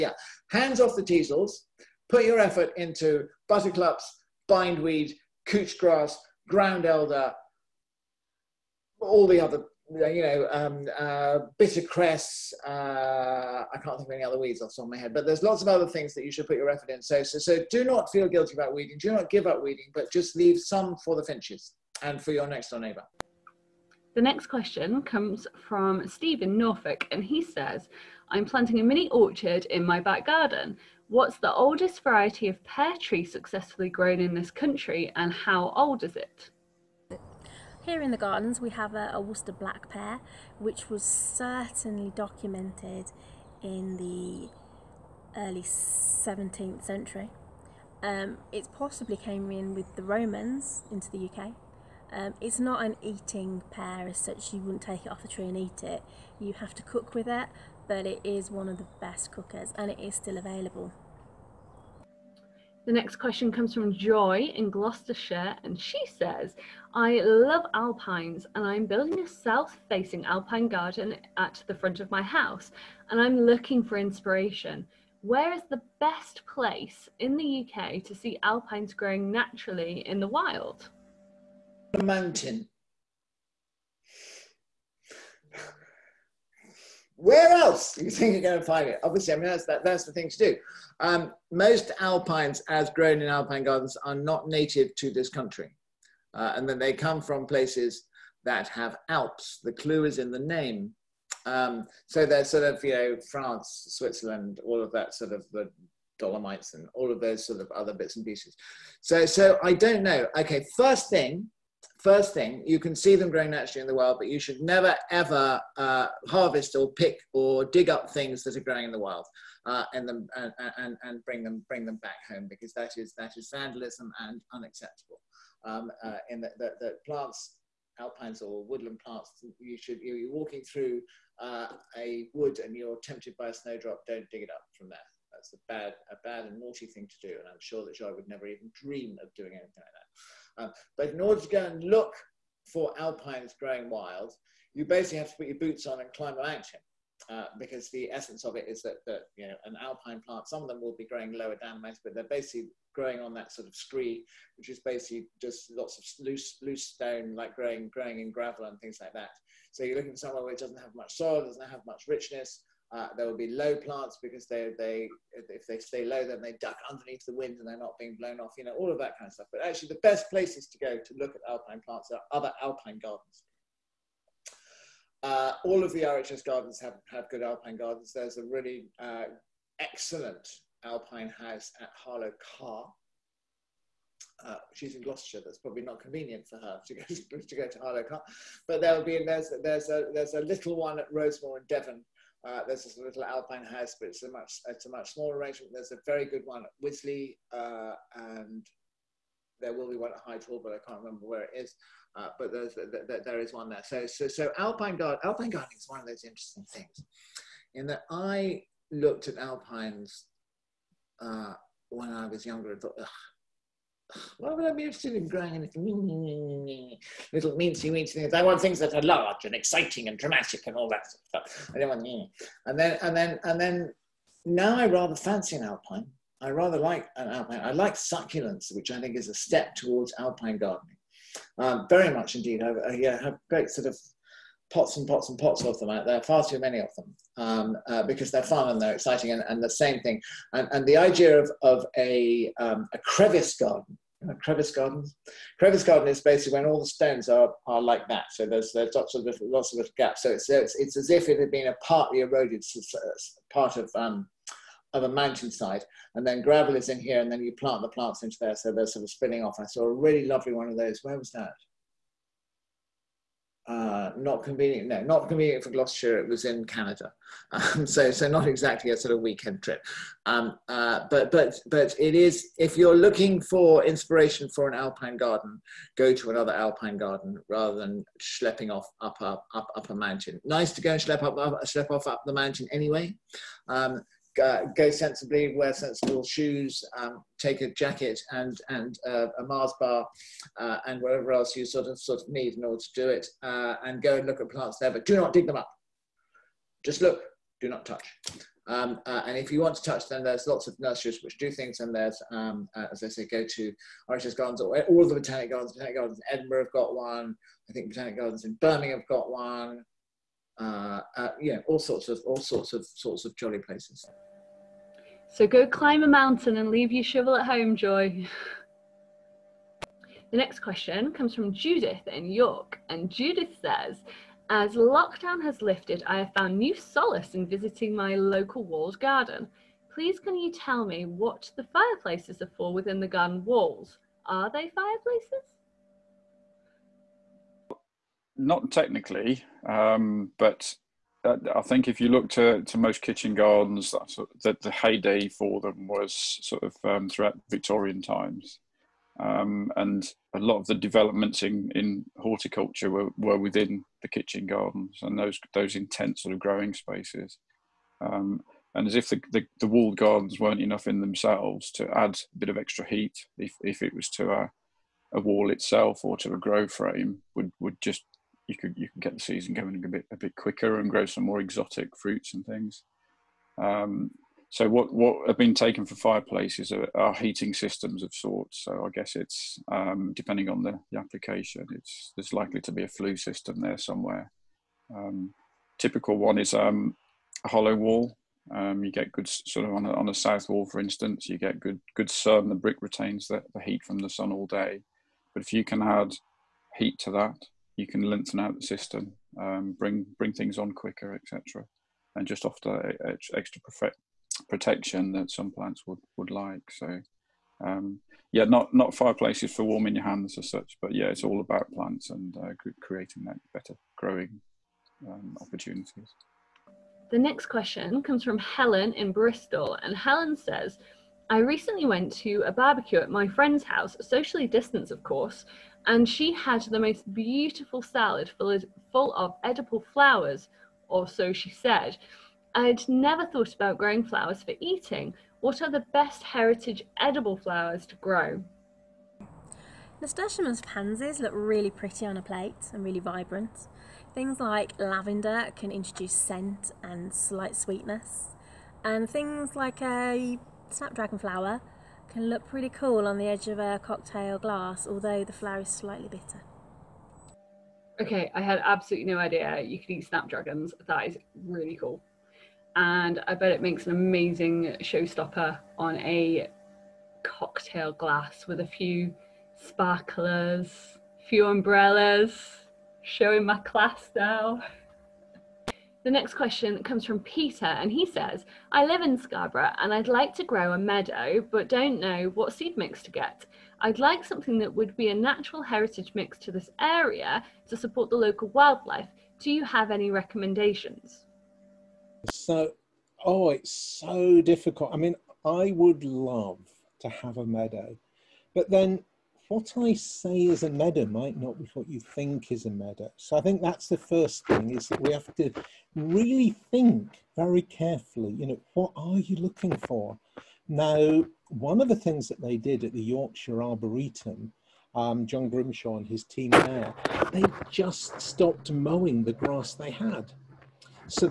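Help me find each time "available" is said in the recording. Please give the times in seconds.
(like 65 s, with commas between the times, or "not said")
60 s.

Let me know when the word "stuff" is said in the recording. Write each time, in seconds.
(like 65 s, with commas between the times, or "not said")
169 s, 221 s.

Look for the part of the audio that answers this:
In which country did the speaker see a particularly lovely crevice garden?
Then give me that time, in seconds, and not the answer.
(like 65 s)
266 s.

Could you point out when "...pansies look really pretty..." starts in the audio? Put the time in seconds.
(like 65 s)
440 s.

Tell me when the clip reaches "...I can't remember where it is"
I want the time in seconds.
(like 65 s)
200 s.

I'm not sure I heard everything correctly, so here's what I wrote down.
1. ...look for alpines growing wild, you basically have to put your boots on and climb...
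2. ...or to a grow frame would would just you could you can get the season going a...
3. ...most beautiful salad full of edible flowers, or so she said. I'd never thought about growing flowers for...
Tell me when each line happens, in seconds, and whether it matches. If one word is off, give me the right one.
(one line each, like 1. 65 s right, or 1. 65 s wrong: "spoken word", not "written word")
1. 141 s right
2. 366 s right
3. 426 s right.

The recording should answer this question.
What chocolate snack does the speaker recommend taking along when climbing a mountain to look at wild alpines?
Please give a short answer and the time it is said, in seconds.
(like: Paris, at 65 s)
Mars bar, at 289 s.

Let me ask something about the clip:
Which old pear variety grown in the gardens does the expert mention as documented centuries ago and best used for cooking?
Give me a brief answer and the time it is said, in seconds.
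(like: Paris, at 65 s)
Worcester black pear, at 39 s.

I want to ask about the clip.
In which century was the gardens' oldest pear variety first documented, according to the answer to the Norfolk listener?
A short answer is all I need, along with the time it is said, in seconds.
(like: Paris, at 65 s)
17th century, at 45 s.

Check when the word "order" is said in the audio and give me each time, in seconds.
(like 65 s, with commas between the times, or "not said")
141 s, 292 s.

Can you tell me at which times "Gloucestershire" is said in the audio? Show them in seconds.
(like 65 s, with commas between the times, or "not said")
64 s, 185 s, 265 s.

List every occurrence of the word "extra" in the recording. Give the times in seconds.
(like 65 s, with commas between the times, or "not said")
362 s, 403 s.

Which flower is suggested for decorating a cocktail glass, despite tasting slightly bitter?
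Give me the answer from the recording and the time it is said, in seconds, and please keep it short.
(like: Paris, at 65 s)
Snapdragon, at 450 s.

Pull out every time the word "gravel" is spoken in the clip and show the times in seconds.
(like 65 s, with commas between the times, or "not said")
158 s, 256 s.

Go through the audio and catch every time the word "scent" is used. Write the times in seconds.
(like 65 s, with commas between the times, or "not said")
446 s.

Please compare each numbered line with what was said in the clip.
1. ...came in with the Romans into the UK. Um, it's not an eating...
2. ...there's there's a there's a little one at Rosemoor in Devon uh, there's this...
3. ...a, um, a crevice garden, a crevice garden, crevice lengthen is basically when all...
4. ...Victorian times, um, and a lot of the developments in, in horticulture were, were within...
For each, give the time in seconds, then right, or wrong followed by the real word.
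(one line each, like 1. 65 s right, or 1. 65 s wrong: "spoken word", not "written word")
1. 49 s right
2. 189 s right
3. 241 s wrong: "garden", not "lengthen"
4. 347 s right.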